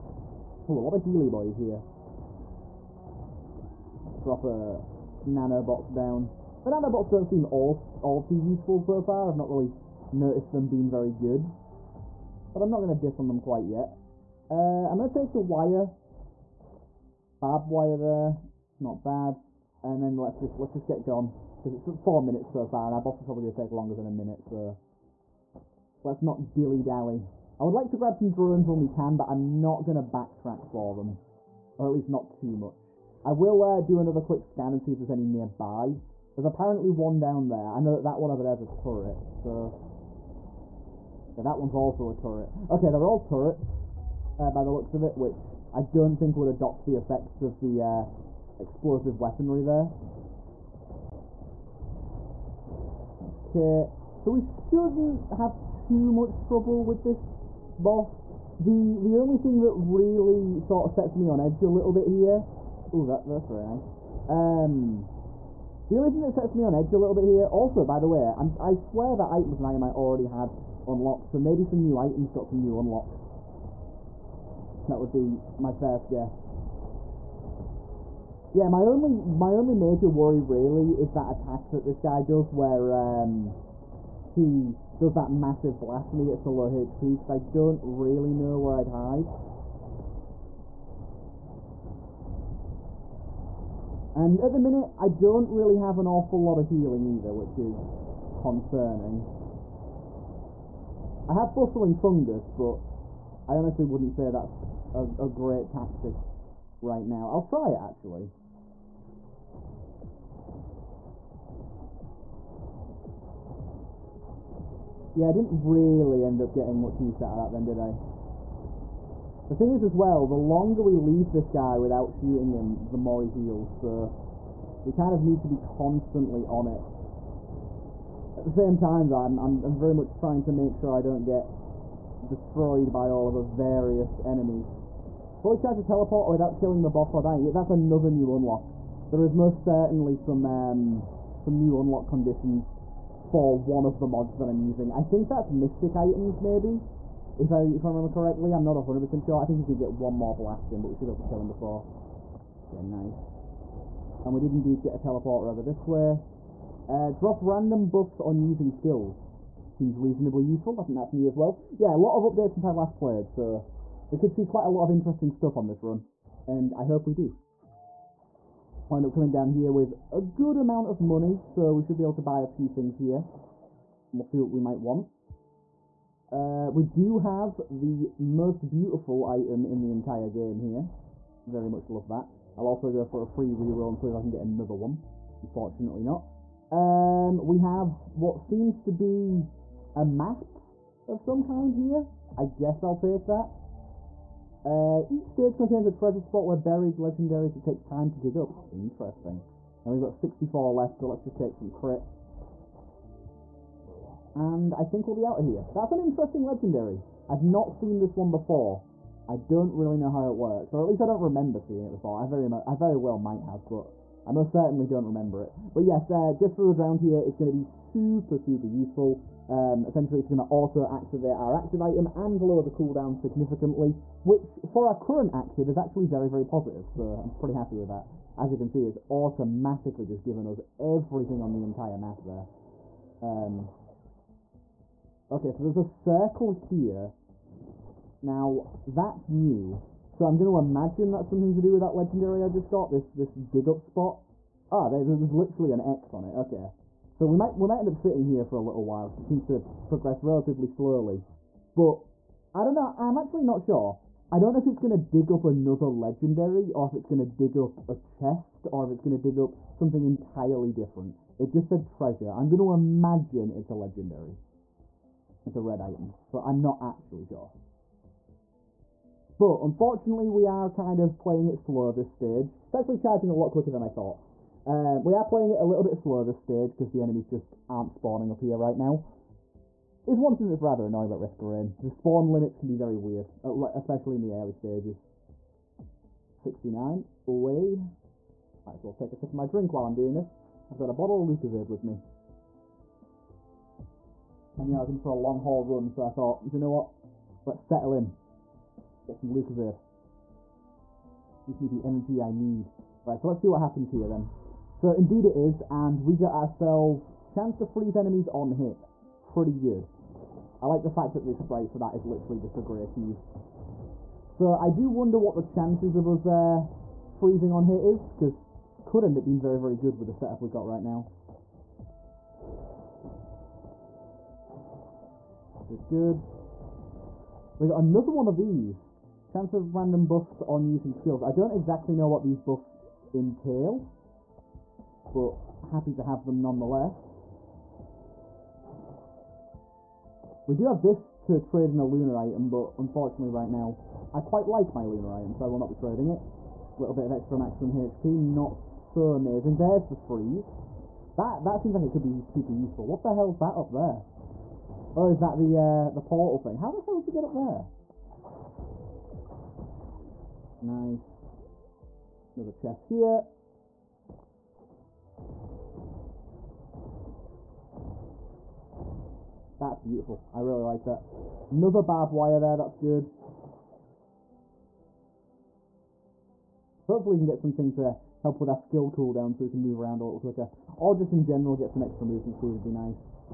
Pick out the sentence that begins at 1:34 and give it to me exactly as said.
And at the minute, I don't really have an awful lot of healing either, which is concerning.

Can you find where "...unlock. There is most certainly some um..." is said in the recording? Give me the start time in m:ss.
2:18.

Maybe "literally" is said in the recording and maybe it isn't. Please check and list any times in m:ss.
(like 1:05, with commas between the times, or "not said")
4:05, 5:12.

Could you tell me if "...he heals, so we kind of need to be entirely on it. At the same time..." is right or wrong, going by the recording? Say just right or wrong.
wrong.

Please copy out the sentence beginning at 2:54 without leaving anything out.
we'll see what we might want.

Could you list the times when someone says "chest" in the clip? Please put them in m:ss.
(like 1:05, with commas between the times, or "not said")
4:17, 6:02.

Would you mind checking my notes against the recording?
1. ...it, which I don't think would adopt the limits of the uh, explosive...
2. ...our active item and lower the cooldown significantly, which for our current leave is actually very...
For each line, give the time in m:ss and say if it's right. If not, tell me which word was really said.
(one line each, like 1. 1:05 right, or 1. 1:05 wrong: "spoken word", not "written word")
1. 0:45 wrong: "effects", not "limits"
2. 3:41 wrong: "active", not "leave".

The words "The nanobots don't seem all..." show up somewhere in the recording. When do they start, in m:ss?
0:06.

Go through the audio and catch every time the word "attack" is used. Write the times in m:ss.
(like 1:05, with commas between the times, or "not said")
1:21.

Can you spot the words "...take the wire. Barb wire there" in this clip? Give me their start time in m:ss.
0:15.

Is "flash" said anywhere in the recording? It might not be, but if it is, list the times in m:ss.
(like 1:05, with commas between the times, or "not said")
not said.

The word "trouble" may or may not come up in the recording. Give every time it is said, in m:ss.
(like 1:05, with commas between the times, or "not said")
0:56.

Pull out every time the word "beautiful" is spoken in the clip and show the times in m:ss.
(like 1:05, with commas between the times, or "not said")
2:58, 6:09.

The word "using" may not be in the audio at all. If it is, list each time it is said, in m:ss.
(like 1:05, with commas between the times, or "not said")
2:24, 2:38, 5:30.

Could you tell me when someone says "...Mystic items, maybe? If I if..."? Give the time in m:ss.
2:25.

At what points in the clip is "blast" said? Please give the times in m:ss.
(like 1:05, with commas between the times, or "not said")
1:25, 2:30.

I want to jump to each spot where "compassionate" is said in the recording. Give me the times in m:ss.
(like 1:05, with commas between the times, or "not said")
not said.